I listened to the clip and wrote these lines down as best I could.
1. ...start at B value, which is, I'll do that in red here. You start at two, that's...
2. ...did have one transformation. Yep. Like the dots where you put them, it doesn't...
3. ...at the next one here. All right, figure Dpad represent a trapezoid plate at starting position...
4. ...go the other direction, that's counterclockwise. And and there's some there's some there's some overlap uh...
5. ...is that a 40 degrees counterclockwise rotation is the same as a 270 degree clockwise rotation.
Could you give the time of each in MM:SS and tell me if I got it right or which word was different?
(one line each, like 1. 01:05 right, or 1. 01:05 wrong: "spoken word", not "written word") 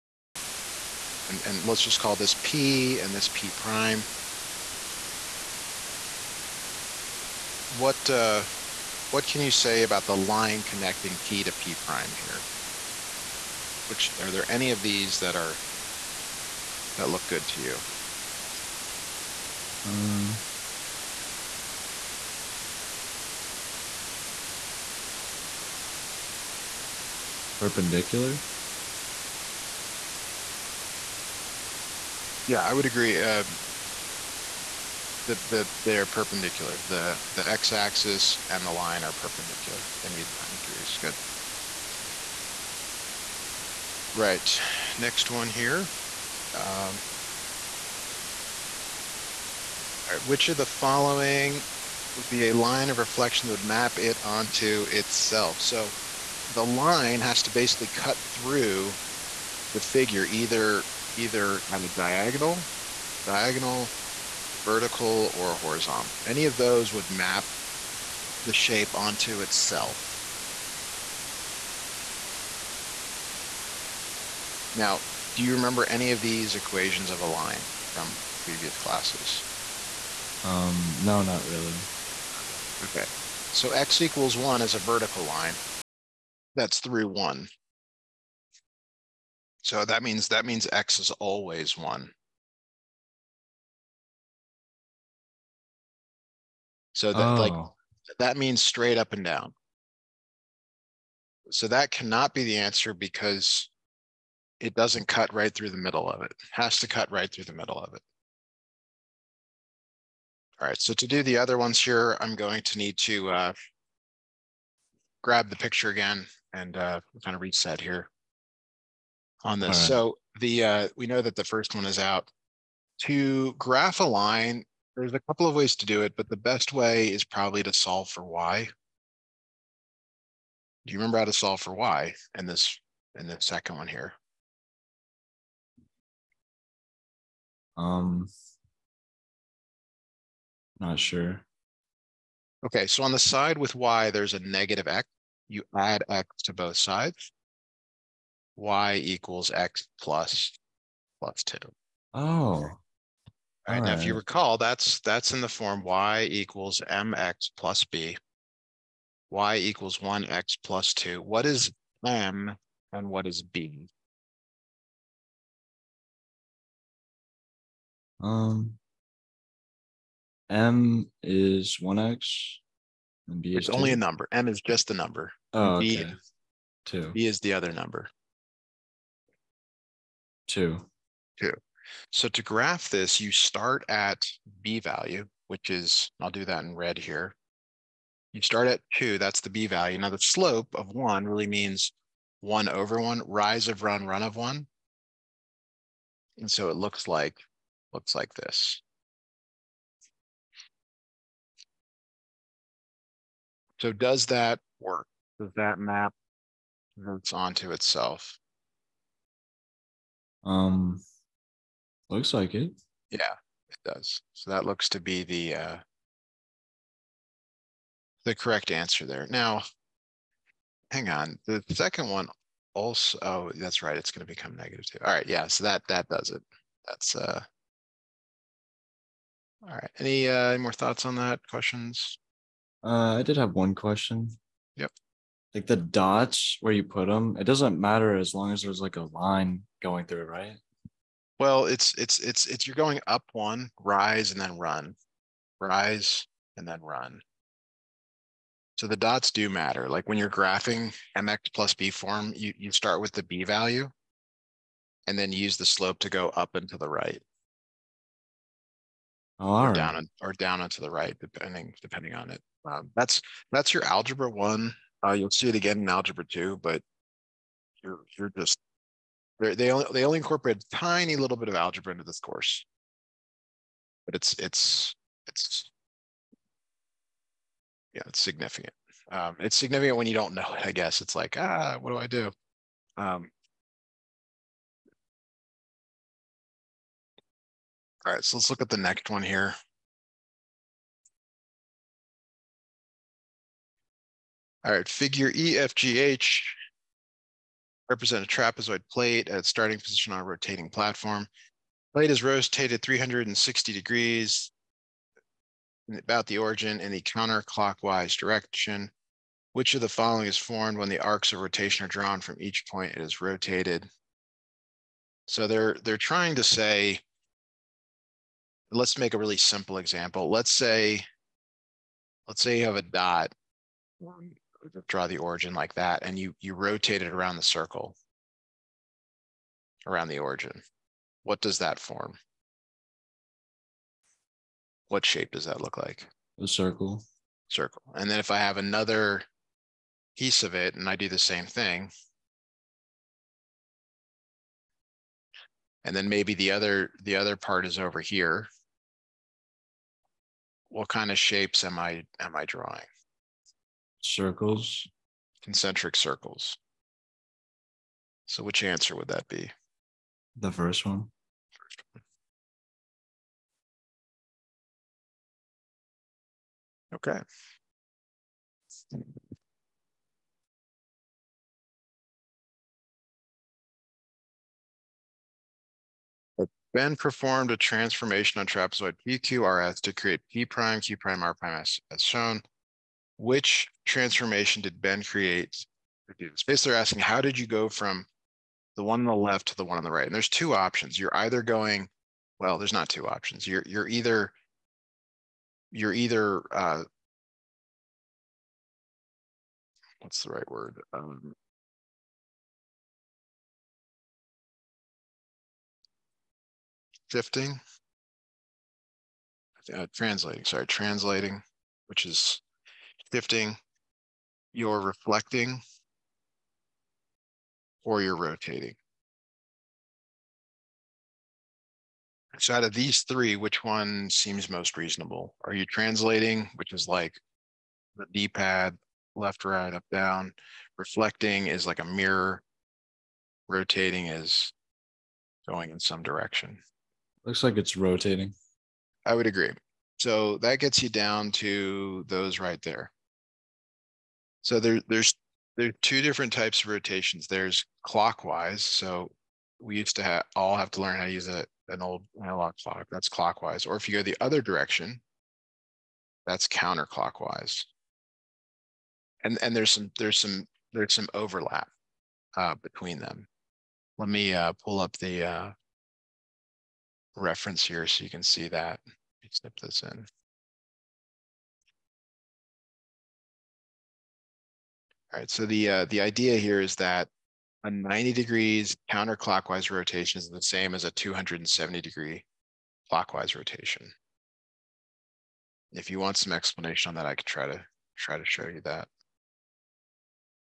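1. 03:03 right
2. 03:53 wrong: "question", not "transformation"
3. 04:48 wrong: "EFGH", not "Dpad"
4. 07:33 right
5. 07:56 wrong: "90", not "40".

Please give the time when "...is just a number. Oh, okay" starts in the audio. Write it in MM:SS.
02:54.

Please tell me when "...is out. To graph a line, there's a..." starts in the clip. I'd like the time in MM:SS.
02:01.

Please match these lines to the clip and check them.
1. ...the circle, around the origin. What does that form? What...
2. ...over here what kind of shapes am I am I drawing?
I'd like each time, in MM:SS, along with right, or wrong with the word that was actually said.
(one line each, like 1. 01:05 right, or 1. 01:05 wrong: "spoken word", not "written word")
1. 05:27 right
2. 05:47 right.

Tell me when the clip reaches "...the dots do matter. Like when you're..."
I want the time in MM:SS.
04:08.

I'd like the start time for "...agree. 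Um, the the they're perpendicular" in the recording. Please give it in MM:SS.
00:32.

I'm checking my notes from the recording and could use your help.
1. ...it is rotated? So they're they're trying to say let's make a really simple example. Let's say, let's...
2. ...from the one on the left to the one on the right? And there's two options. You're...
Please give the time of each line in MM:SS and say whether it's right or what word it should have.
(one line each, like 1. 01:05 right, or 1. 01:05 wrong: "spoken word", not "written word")
1. 05:12 right
2. 06:27 right.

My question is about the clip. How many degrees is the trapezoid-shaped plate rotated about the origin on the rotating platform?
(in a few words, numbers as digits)
360 degrees.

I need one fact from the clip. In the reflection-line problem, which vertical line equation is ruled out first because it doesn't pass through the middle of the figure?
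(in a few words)
x = 1.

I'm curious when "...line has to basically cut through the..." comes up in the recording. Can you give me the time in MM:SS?
00:56.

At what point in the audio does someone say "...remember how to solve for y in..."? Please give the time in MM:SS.
02:10.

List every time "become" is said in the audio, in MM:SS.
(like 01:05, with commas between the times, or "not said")
03:44.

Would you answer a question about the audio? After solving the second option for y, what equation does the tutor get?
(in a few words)
y = x + 2.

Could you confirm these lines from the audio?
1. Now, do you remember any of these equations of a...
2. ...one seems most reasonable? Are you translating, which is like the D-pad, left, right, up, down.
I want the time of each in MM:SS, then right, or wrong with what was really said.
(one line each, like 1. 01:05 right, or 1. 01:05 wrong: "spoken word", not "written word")
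1. 01:14 right
2. 07:03 right.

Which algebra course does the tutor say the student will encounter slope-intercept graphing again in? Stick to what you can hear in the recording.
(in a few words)
Algebra 2.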